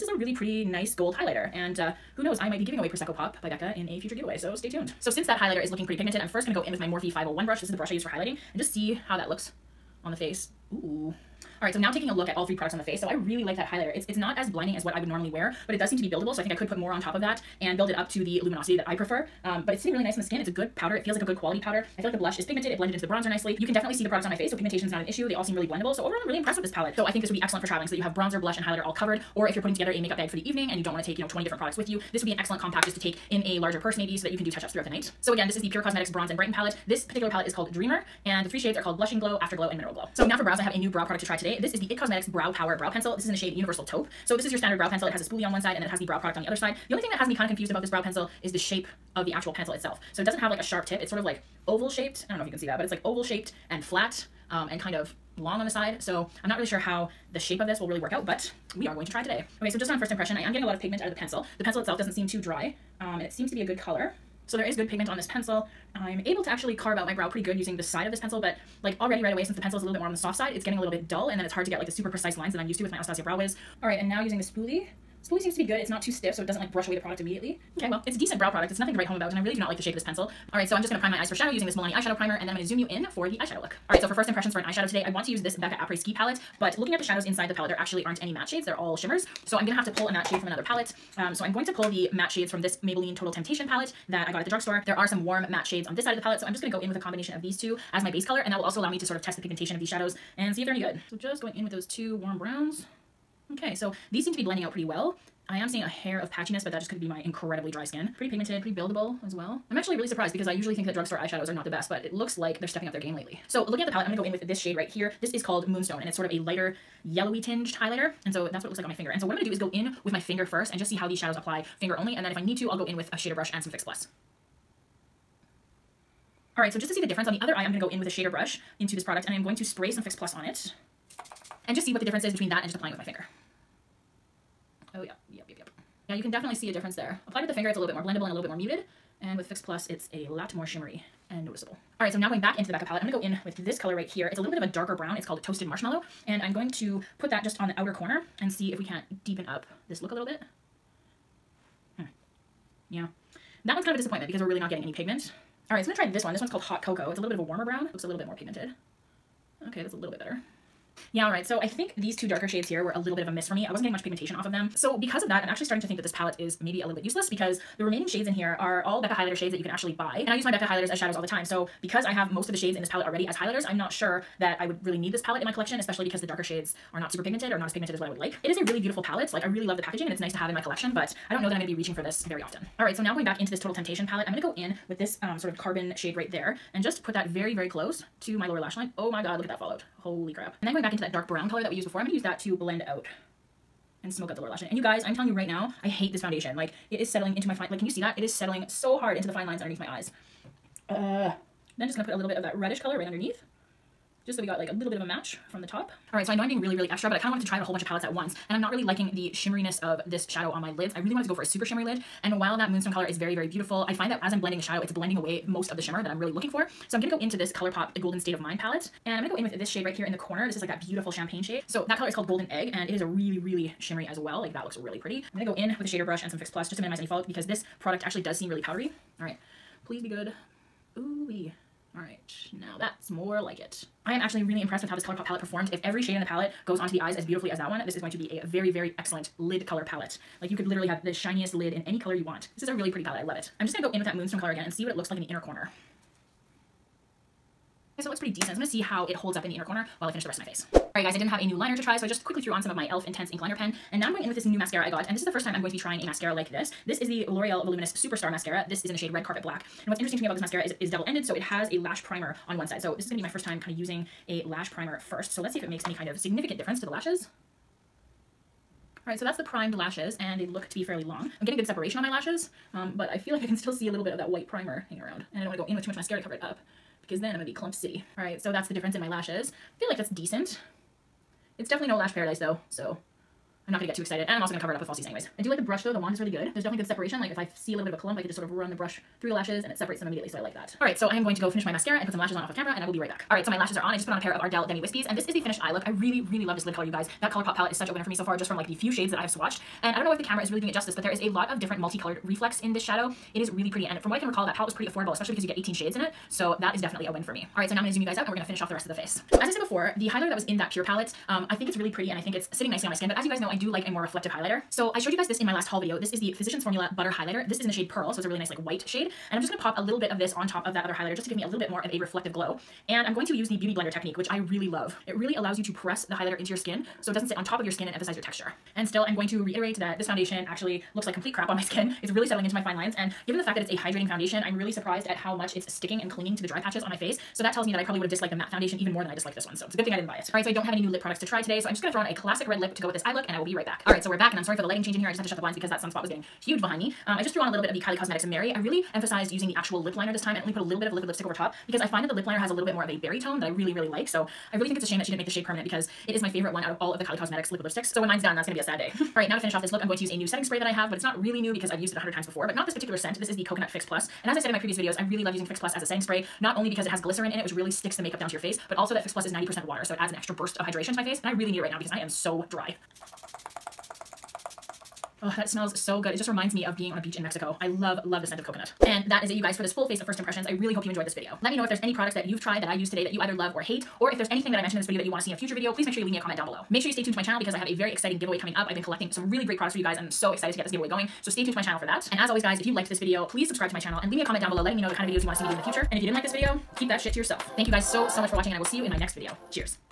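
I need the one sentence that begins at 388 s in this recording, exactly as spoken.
I've been collecting some really great products for you guys and I'm so excited to get this giveaway going.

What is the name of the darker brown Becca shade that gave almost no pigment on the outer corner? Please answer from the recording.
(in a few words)
Toasted Marshmallow.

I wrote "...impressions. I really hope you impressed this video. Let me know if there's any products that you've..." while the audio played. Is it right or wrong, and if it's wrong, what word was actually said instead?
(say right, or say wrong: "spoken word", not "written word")
wrong: "enjoyed", not "impressed".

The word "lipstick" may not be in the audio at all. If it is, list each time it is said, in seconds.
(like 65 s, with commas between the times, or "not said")
351 s, 357 s.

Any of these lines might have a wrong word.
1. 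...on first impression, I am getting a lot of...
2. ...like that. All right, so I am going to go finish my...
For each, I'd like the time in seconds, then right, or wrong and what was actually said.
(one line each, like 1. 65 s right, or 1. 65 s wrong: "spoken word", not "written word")
1. 59 s right
2. 290 s right.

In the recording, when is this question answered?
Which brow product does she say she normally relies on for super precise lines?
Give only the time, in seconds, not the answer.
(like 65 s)
72 s.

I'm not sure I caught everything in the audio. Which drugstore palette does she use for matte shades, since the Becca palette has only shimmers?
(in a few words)
Maybelline Total Temptation.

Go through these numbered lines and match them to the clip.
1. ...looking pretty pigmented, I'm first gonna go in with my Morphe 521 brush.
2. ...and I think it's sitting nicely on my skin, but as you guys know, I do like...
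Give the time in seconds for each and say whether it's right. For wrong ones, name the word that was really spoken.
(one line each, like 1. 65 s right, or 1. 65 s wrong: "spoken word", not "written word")
1. 5 s wrong: "501", not "521"
2. 312 s right.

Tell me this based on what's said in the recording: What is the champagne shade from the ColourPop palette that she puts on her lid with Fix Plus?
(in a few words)
Golden Egg.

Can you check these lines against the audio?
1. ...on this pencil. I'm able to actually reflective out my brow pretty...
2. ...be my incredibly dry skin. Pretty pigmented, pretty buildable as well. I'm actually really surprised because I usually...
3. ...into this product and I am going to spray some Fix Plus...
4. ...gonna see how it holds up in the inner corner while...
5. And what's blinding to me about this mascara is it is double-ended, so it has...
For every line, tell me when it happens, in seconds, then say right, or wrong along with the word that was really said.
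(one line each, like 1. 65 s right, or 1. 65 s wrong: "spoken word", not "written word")
1. 65 s wrong: "carve", not "reflective"
2. 107 s right
3. 128 s right
4. 248 s right
5. 259 s wrong: "interesting", not "blinding".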